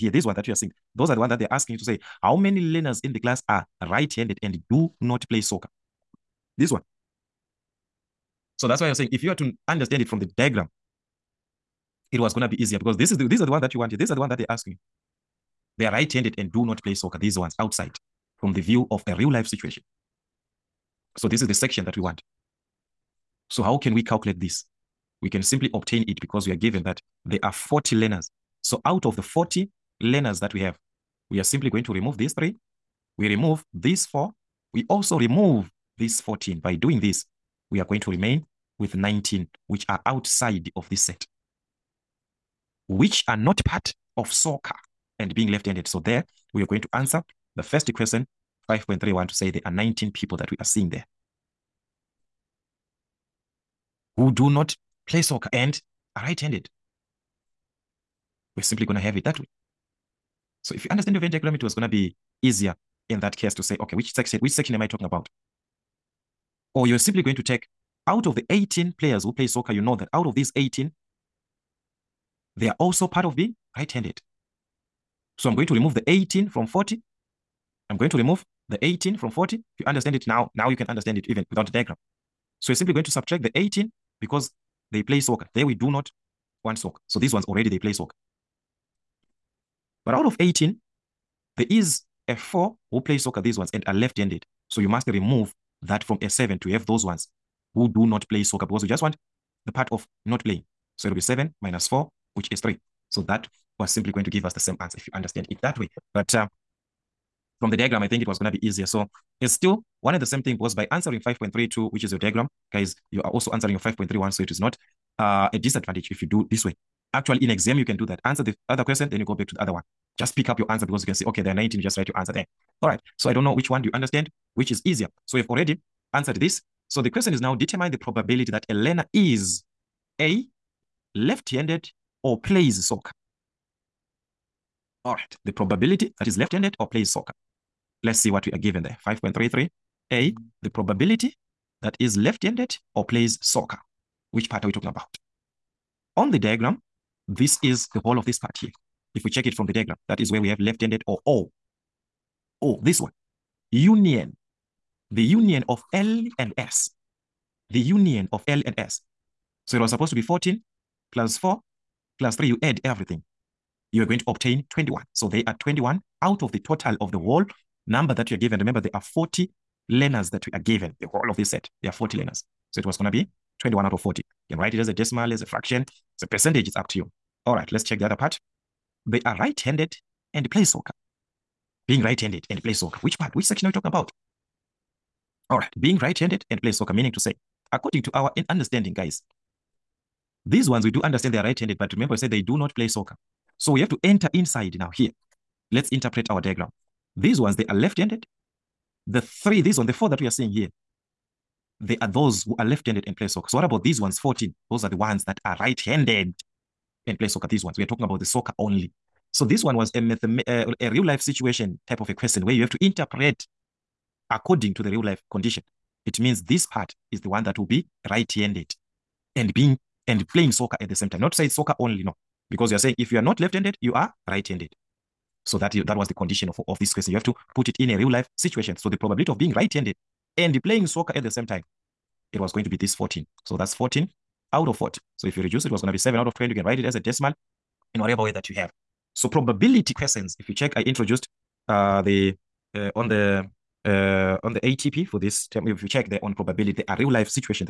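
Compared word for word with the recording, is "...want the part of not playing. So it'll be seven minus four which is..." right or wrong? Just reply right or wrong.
right.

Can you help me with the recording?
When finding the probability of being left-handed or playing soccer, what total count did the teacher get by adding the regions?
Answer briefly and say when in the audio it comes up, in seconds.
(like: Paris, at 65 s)
21, at 163 s.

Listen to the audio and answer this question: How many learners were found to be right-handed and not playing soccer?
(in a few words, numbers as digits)
19.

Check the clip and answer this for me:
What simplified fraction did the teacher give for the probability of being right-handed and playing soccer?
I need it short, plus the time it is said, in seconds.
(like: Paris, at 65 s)
7/20, at 235 s.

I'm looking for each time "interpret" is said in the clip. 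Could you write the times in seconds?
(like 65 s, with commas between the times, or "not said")
195 s, 212 s.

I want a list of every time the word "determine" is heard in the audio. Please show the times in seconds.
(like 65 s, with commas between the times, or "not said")
127 s.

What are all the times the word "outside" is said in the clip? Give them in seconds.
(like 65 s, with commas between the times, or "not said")
17 s, 40 s.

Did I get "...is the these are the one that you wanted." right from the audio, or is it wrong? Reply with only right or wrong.
right.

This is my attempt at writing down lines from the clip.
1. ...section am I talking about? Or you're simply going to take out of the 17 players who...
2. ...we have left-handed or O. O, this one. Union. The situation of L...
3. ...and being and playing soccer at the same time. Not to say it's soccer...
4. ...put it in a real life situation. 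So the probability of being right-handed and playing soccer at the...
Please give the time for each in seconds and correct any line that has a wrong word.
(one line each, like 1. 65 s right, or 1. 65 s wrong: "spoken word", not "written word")
1. 64 s wrong: "18", not "17"
2. 150 s wrong: "union", not "situation"
3. 219 s right
4. 227 s right.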